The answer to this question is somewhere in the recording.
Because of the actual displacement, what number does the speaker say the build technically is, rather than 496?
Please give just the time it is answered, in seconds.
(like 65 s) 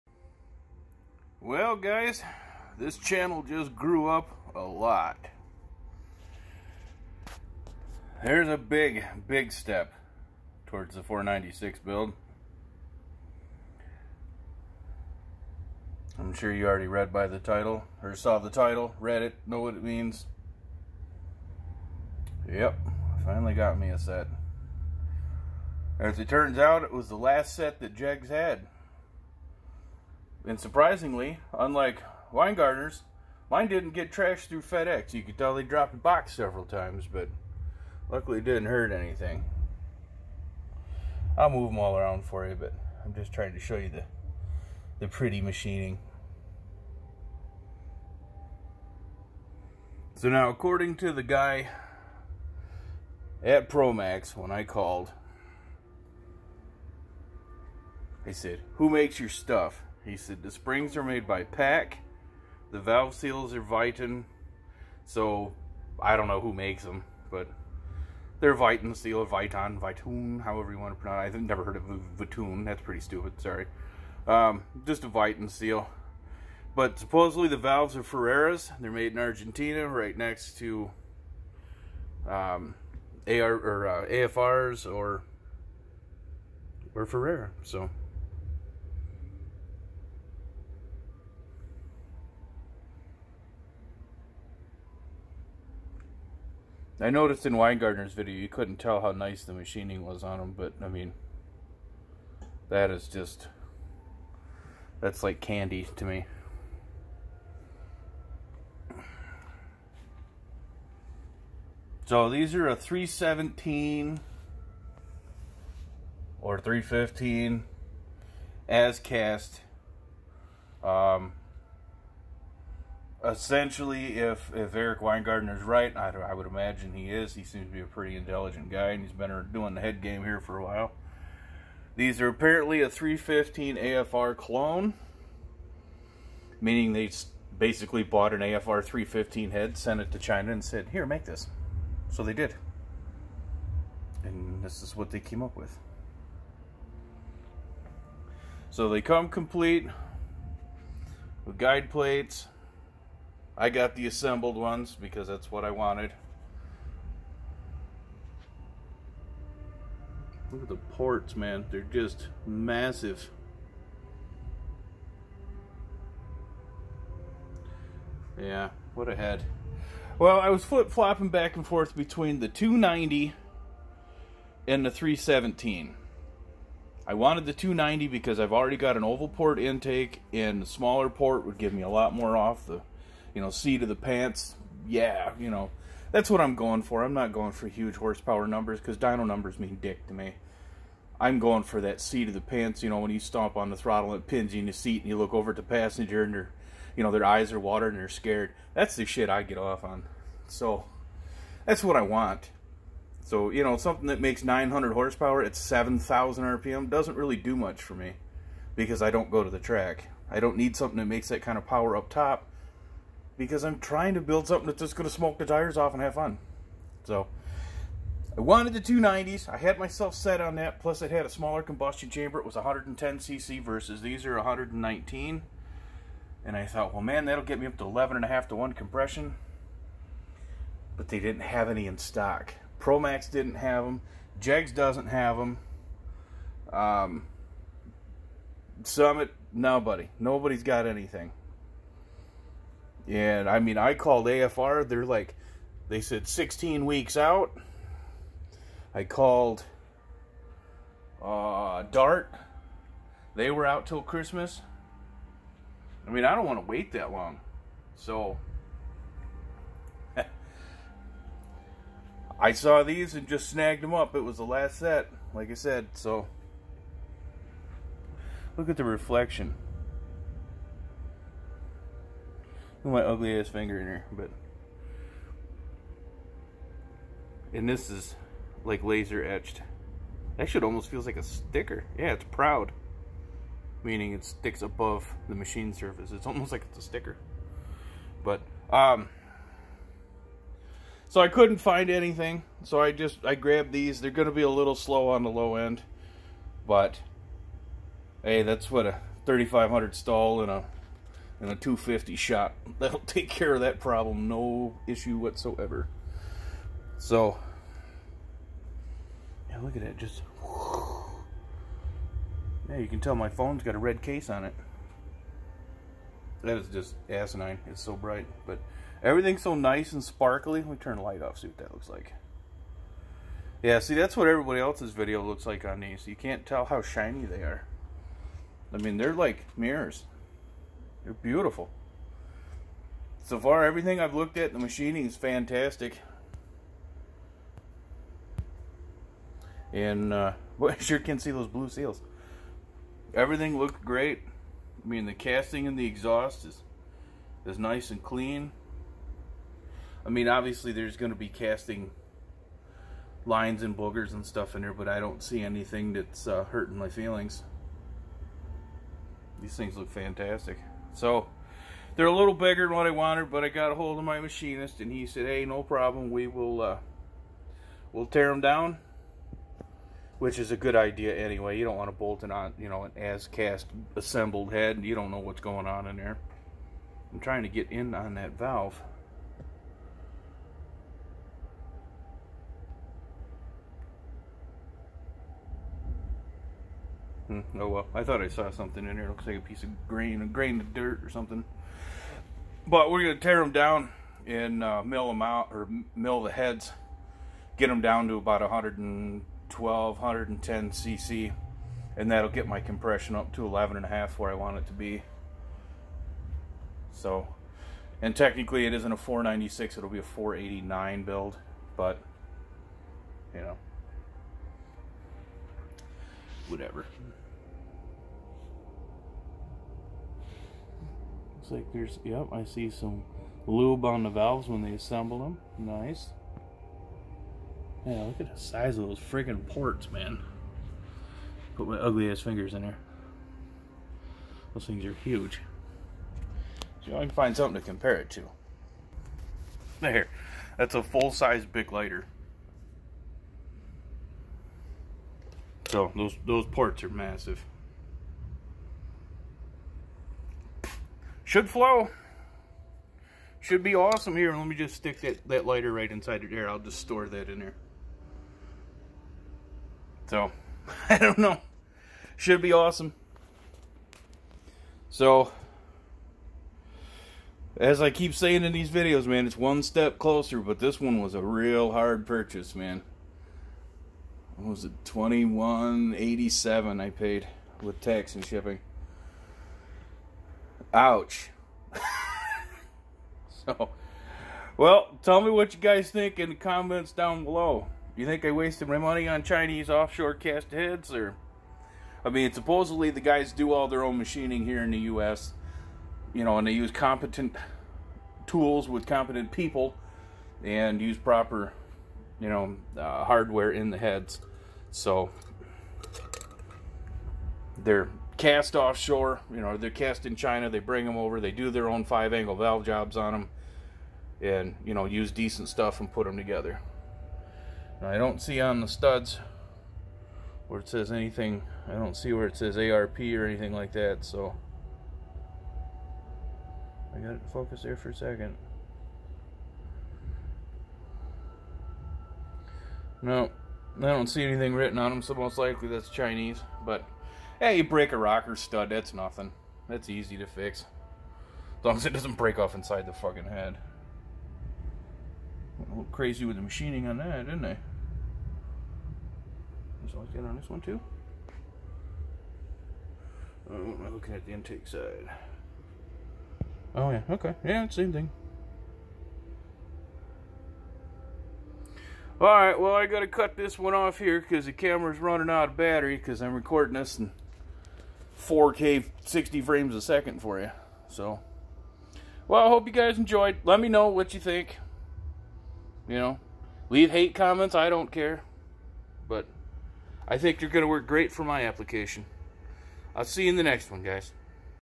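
410 s.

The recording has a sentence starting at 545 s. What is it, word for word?
a little crazy with the machining on that, didn't I?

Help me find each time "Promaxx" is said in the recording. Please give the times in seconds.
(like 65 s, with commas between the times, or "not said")
53 s, 232 s.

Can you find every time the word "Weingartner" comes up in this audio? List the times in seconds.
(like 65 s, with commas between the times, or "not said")
32 s, 97 s, 124 s.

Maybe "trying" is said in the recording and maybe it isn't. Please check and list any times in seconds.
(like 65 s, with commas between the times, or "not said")
43 s, 213 s, 377 s.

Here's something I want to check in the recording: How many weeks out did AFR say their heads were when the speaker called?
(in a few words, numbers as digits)
16 weeks.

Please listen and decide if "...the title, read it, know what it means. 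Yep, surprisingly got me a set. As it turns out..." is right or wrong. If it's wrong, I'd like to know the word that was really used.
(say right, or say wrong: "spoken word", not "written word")
wrong: "finally", not "surprisingly".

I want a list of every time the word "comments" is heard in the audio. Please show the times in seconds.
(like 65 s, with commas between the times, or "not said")
486 s, 577 s.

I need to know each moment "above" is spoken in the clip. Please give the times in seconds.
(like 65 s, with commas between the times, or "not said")
284 s.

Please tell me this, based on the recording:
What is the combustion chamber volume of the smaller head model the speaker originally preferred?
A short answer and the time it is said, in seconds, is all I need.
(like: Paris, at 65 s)
110cc, at 222 s.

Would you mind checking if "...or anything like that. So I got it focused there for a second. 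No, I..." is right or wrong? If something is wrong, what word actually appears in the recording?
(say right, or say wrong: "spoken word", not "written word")
right.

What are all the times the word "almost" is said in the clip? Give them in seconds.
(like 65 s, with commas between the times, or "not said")
280 s, 286 s.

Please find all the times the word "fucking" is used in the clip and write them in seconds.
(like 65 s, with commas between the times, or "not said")
542 s.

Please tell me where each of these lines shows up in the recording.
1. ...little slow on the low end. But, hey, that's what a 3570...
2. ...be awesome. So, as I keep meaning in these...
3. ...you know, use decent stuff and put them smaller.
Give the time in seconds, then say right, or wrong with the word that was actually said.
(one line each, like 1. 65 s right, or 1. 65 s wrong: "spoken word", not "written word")
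1. 294 s wrong: "3500", not "3570"
2. 462 s wrong: "saying", not "meaning"
3. 514 s wrong: "together", not "smaller".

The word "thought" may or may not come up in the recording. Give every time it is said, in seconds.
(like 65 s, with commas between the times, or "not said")
226 s, 388 s.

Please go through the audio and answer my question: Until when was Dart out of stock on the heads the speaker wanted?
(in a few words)
Christmas.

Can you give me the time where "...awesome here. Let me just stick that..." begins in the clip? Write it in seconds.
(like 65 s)
453 s.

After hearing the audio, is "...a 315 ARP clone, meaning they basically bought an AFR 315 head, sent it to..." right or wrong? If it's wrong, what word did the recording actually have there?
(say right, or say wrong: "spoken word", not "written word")
wrong: "AFR", not "ARP".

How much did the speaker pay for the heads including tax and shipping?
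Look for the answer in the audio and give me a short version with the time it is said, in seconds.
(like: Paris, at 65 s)
2187, at 474 s.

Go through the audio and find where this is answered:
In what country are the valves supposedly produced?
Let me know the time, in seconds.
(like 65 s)
79 s.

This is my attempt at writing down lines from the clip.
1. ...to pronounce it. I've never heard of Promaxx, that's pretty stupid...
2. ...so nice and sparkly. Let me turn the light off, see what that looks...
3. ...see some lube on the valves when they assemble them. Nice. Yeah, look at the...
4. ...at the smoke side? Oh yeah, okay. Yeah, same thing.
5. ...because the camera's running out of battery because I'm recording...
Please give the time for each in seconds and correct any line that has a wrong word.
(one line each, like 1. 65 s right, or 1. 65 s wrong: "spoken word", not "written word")
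1. 70 s wrong: "Vitun", not "Promaxx"
2. 319 s right
3. 422 s right
4. 554 s wrong: "intake", not "smoke"
5. 564 s right.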